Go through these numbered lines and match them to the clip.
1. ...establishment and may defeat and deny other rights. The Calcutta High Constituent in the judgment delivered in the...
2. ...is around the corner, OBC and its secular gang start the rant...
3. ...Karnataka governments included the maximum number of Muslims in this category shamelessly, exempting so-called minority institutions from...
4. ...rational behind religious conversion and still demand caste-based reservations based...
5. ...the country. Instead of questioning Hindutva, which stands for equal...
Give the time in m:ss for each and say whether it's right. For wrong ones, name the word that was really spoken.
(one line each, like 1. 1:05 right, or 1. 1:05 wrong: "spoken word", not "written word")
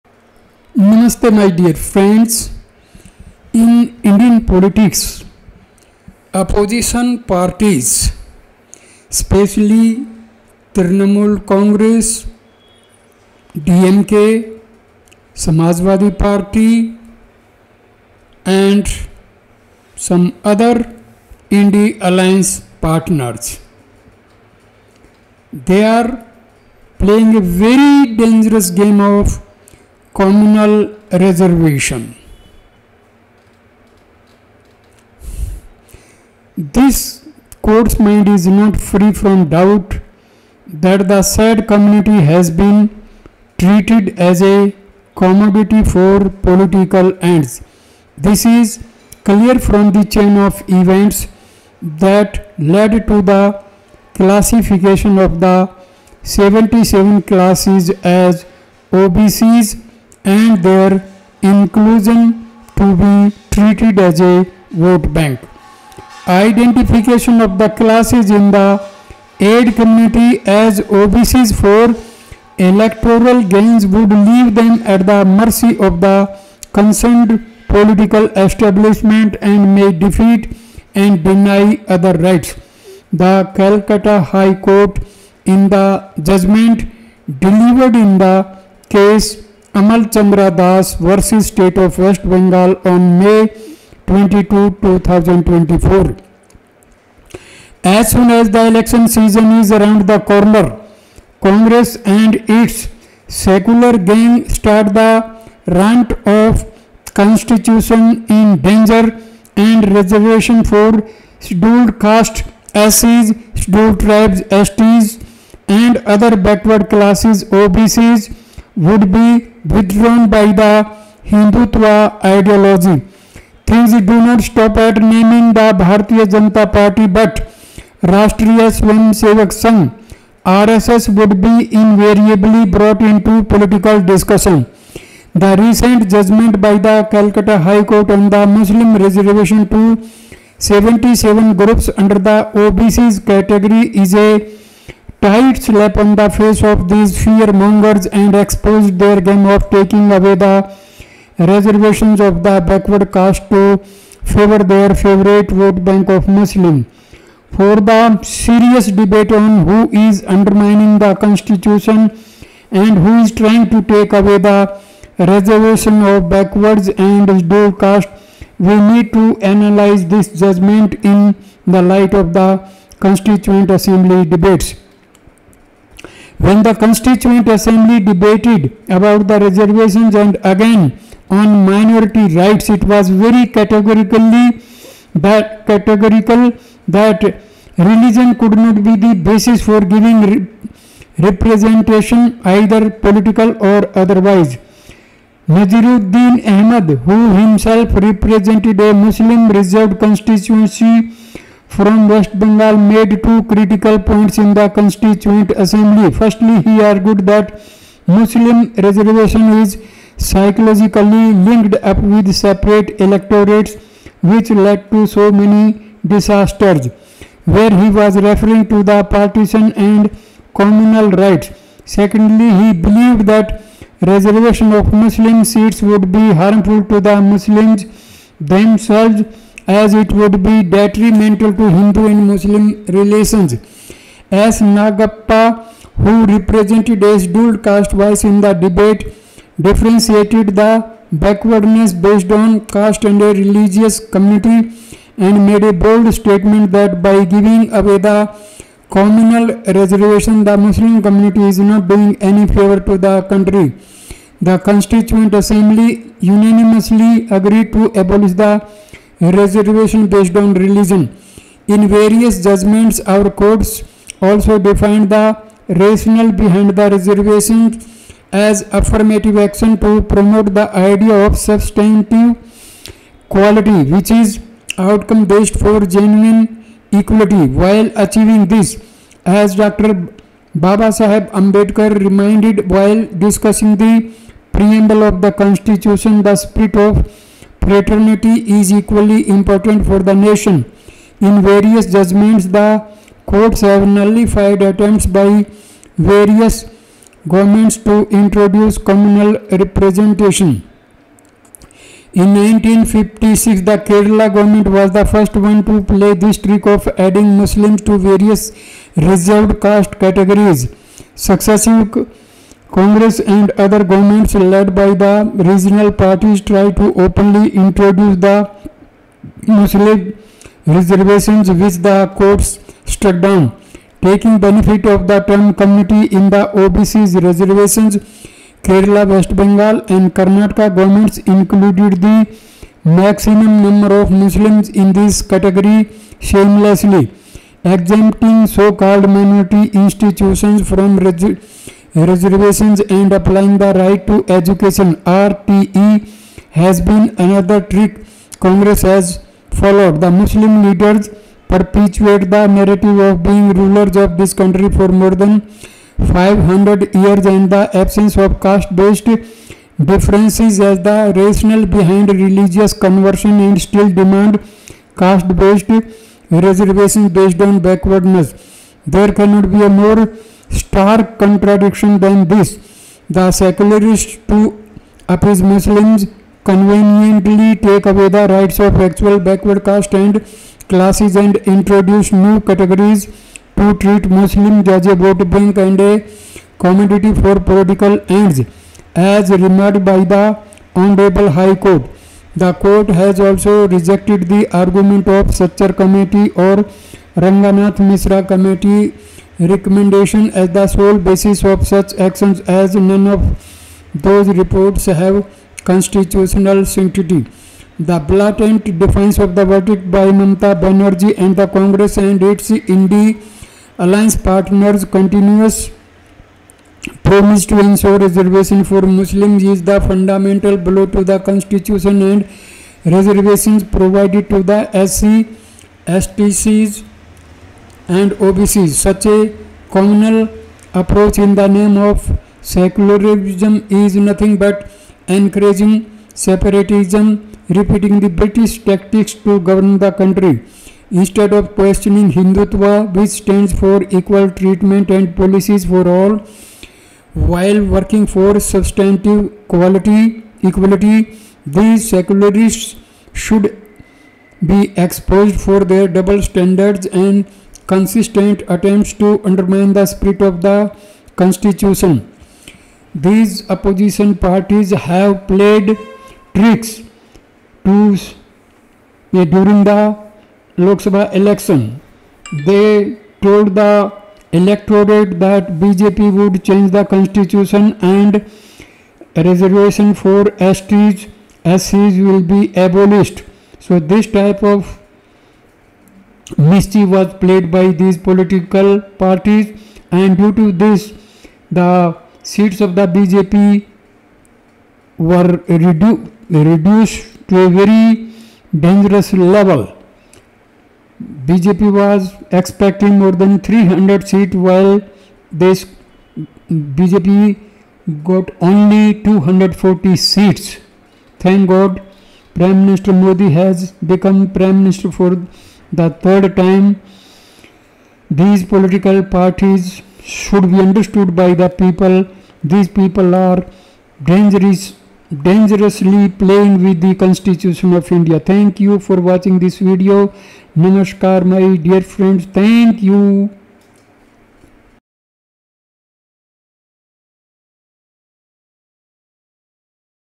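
1. 1:18 wrong: "Court", not "Constituent"
2. 1:39 wrong: "Congress", not "OBC"
3. 5:30 right
4. 6:01 right
5. 7:19 right.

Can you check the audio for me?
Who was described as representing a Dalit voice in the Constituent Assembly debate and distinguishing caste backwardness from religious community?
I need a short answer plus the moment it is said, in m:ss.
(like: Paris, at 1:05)
S. Nagappa, at 3:54.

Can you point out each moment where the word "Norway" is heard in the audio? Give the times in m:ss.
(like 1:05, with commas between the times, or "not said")
not said.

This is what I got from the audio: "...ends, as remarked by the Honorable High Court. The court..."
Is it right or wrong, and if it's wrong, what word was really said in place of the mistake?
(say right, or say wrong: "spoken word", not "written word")
right.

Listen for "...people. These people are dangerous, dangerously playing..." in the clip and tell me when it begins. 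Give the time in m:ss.
8:41.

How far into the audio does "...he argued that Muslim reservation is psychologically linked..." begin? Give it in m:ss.
3:26.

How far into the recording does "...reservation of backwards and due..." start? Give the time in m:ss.
2:45.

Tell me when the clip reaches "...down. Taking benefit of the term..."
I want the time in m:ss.
5:23.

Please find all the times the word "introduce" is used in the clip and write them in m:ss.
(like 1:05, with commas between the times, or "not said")
4:58, 5:17, 6:21.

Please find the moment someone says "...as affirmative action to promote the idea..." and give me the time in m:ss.
4:28.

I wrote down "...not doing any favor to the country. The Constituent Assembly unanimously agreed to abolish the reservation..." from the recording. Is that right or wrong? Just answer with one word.
right.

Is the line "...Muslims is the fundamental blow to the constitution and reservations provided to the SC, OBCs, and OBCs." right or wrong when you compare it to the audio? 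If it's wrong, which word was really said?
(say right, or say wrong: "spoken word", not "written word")
wrong: "STCs", not "OBCs".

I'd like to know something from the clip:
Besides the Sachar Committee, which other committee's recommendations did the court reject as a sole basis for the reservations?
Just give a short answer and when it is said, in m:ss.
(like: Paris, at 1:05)
Ranganath Misra Committee, at 6:37.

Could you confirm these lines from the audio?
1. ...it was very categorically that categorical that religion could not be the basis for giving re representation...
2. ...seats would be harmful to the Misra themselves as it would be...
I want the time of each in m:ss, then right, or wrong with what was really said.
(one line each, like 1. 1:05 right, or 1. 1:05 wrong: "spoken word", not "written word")
1. 3:02 right
2. 3:45 wrong: "Muslims", not "Misra".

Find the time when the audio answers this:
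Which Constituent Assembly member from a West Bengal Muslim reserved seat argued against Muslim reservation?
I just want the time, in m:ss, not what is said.
3:15.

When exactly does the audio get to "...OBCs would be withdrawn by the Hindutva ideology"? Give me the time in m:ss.
1:57.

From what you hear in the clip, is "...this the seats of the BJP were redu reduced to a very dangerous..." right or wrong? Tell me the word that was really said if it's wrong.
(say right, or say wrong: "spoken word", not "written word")
right.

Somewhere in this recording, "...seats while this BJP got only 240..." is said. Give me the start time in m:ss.
8:24.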